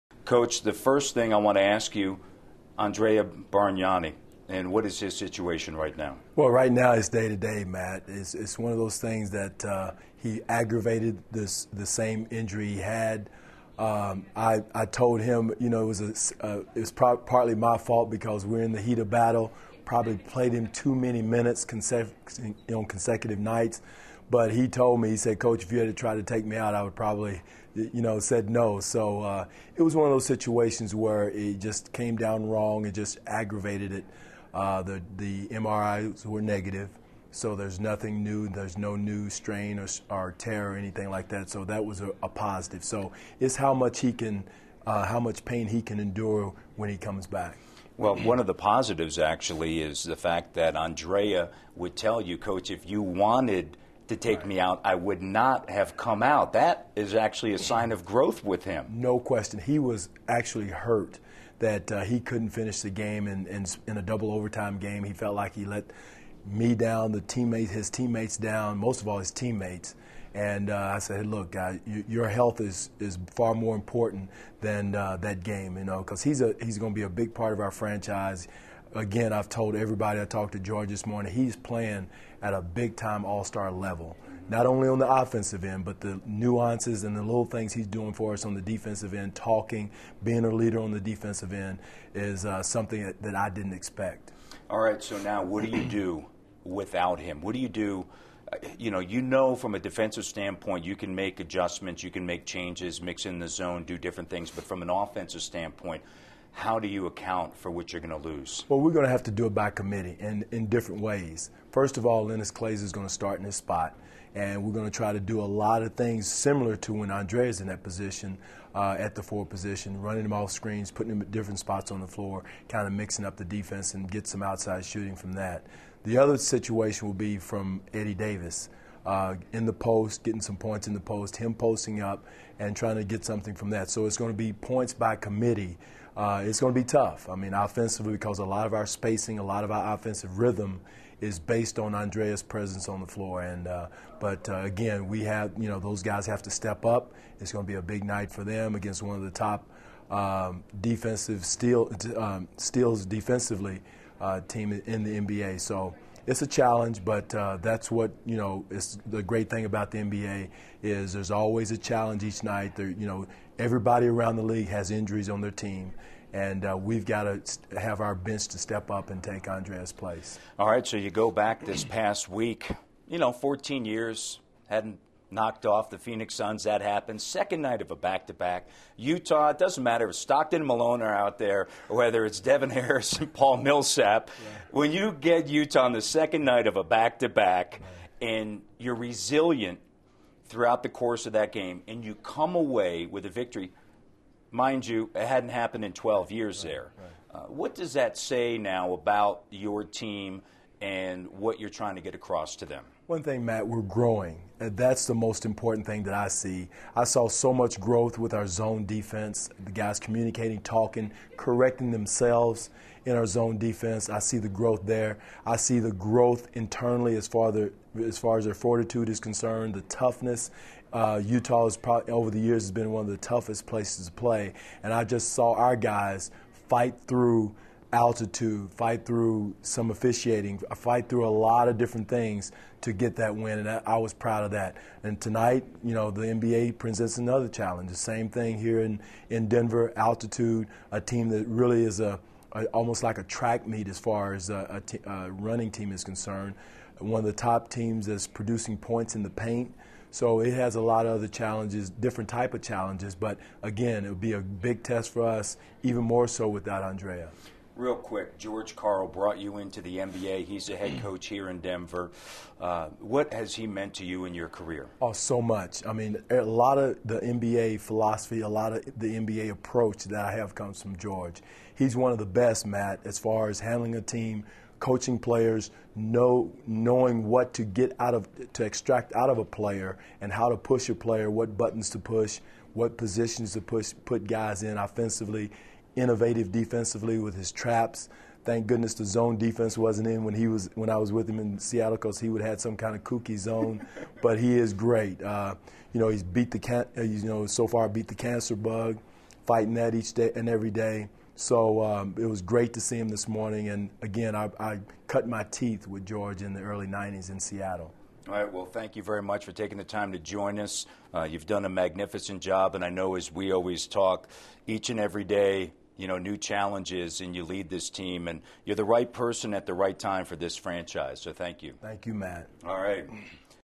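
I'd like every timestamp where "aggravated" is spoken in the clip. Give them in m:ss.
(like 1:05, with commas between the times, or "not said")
0:10, 0:33.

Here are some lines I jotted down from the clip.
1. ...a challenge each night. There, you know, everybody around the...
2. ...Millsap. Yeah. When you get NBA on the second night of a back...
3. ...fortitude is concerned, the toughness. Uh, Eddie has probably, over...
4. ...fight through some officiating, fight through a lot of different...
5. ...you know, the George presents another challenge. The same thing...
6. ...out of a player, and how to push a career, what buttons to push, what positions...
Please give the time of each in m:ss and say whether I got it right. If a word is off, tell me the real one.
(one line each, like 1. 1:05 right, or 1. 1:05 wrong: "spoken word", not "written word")
1. 2:41 right
2. 3:03 wrong: "Utah", not "NBA"
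3. 3:38 wrong: "Utah", not "Eddie"
4. 3:48 right
5. 3:55 wrong: "NBA", not "George"
6. 4:39 wrong: "player", not "career".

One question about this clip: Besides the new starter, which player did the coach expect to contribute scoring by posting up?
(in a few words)
Eddie Davis.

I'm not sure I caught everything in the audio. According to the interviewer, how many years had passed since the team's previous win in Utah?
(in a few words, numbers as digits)
12.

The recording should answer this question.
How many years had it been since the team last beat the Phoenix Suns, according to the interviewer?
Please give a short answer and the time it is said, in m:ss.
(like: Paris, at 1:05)
14, at 2:53.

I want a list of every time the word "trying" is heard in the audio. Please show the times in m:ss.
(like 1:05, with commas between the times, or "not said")
2:12, 3:21.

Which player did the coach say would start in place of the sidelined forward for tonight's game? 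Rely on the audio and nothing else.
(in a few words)
Linas Kleiza.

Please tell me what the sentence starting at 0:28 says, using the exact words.
So uh, it was one of those situations where it just came down wrong.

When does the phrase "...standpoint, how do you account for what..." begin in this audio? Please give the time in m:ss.
1:45.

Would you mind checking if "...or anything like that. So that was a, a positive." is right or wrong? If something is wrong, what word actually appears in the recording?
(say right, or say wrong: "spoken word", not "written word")
right.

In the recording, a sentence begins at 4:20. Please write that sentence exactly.
He's a head coach here in Denver.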